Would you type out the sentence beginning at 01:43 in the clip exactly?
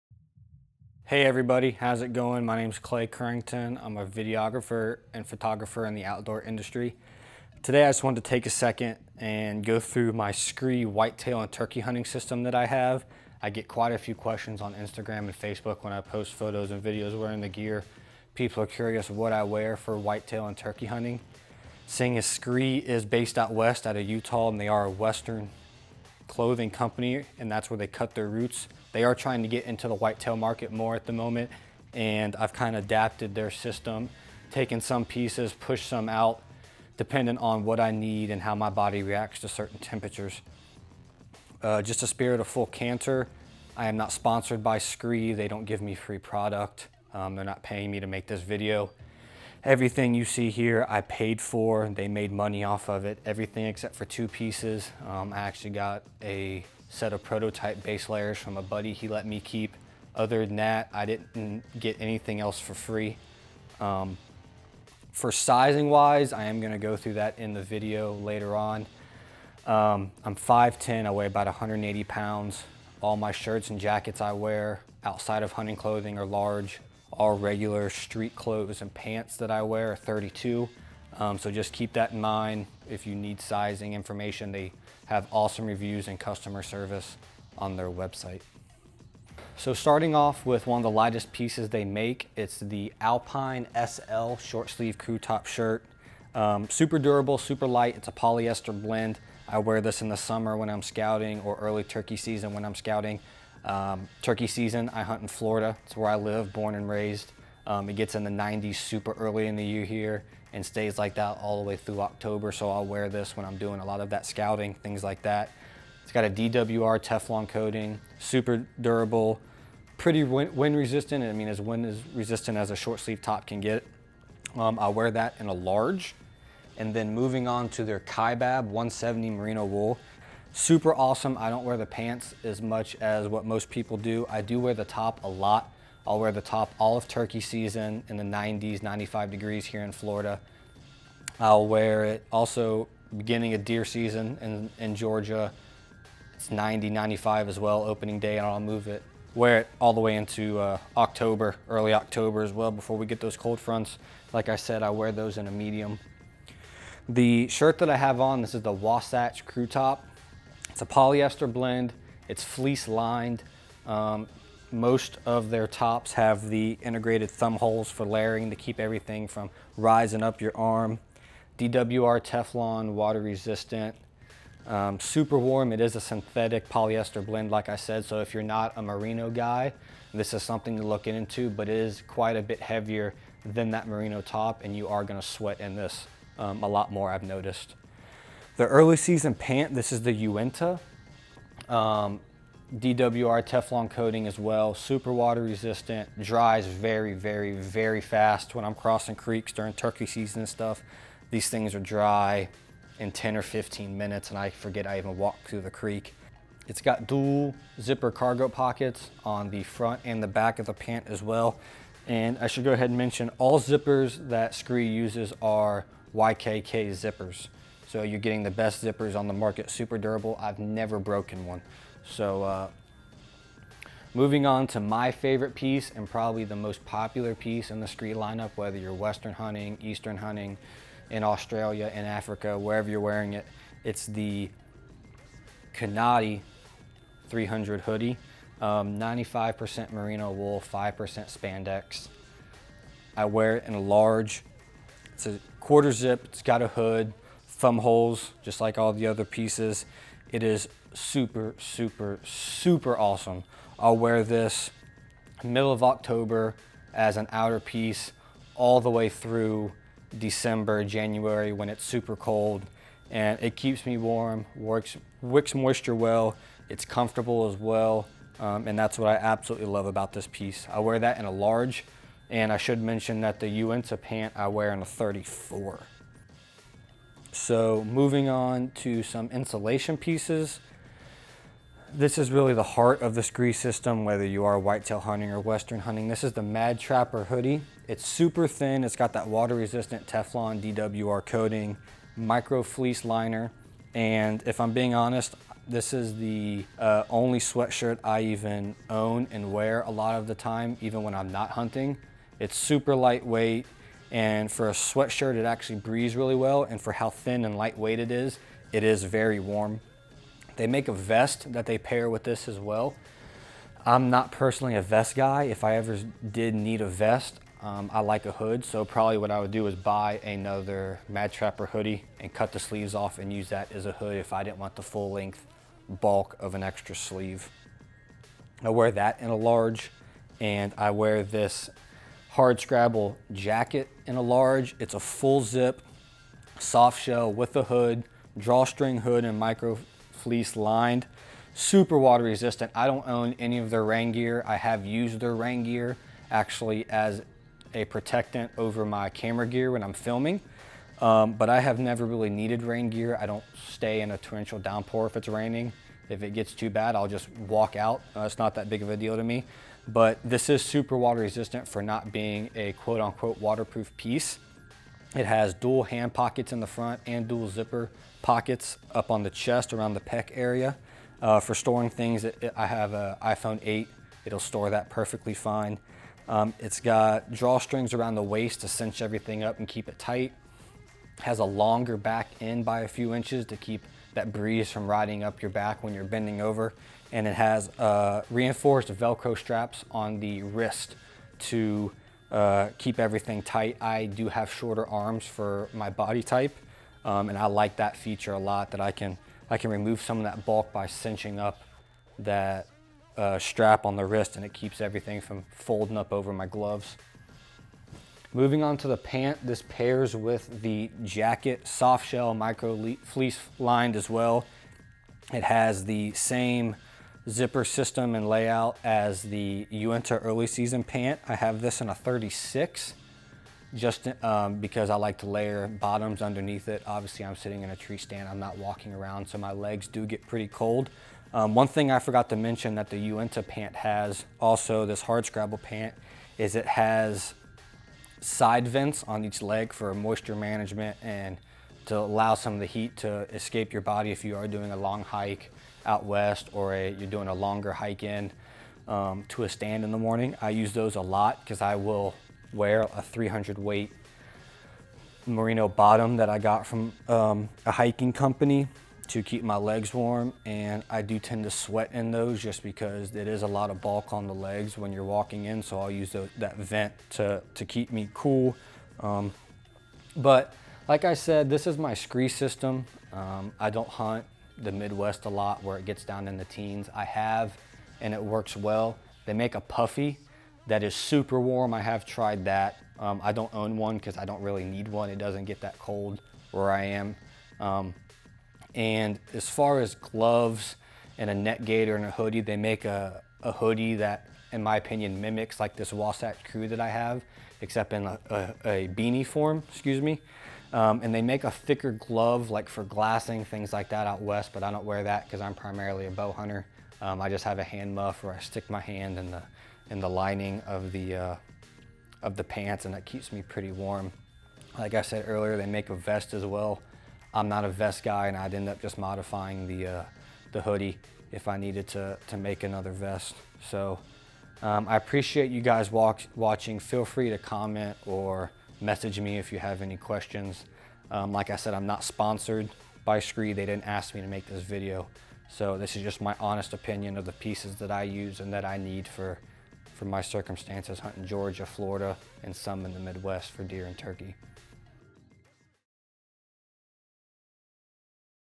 Um, turkey season, I hunt in Florida.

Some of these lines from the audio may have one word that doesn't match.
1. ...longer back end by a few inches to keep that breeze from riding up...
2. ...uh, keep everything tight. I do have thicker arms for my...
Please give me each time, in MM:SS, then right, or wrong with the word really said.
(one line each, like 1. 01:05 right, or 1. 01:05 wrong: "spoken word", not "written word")
1. 06:21 right
2. 06:32 wrong: "shorter", not "thicker".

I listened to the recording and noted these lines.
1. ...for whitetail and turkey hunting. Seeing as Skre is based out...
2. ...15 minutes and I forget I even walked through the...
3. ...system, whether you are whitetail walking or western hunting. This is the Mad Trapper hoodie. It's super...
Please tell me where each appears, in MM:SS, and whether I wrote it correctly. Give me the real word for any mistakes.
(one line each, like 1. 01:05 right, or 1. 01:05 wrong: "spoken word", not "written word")
1. 00:19 right
2. 03:23 right
3. 04:43 wrong: "hunting", not "walking".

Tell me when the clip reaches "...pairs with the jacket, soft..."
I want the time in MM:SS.
06:49.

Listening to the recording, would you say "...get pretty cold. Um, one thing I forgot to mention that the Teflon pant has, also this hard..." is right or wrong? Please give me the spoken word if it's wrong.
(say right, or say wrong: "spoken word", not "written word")
wrong: "Uinta", not "Teflon".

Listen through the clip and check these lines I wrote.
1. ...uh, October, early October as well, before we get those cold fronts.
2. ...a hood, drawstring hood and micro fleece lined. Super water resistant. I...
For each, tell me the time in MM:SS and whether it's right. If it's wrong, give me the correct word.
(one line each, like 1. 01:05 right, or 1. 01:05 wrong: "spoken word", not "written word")
1. 02:30 right
2. 05:37 right.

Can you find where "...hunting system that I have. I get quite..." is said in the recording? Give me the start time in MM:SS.
00:11.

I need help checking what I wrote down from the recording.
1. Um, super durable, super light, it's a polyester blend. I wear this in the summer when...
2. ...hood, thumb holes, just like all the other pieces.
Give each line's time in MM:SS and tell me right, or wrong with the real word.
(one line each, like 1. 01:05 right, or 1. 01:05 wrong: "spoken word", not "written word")
1. 01:36 right
2. 04:06 right.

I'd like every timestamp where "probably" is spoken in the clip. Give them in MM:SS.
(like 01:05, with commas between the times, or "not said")
03:46, 05:18.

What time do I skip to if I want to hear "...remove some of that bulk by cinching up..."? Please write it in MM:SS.
06:39.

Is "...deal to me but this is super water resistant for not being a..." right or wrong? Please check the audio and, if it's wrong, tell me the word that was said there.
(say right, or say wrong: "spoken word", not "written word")
right.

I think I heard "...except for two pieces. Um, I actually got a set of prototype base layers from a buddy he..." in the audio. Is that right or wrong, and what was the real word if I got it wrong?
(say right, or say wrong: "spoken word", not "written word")
right.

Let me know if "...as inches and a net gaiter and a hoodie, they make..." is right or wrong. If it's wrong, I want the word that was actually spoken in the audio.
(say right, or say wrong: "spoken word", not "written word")
wrong: "gloves", not "inches".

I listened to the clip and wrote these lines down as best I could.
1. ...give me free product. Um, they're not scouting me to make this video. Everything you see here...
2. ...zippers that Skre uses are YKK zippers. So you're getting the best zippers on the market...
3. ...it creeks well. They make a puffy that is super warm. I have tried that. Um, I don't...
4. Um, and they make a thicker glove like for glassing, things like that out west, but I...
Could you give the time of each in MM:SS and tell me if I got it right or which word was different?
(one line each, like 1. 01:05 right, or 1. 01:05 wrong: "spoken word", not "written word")
1. 00:45 wrong: "paying", not "scouting"
2. 03:33 right
3. 07:58 wrong: "works", not "creeks"
4. 08:20 right.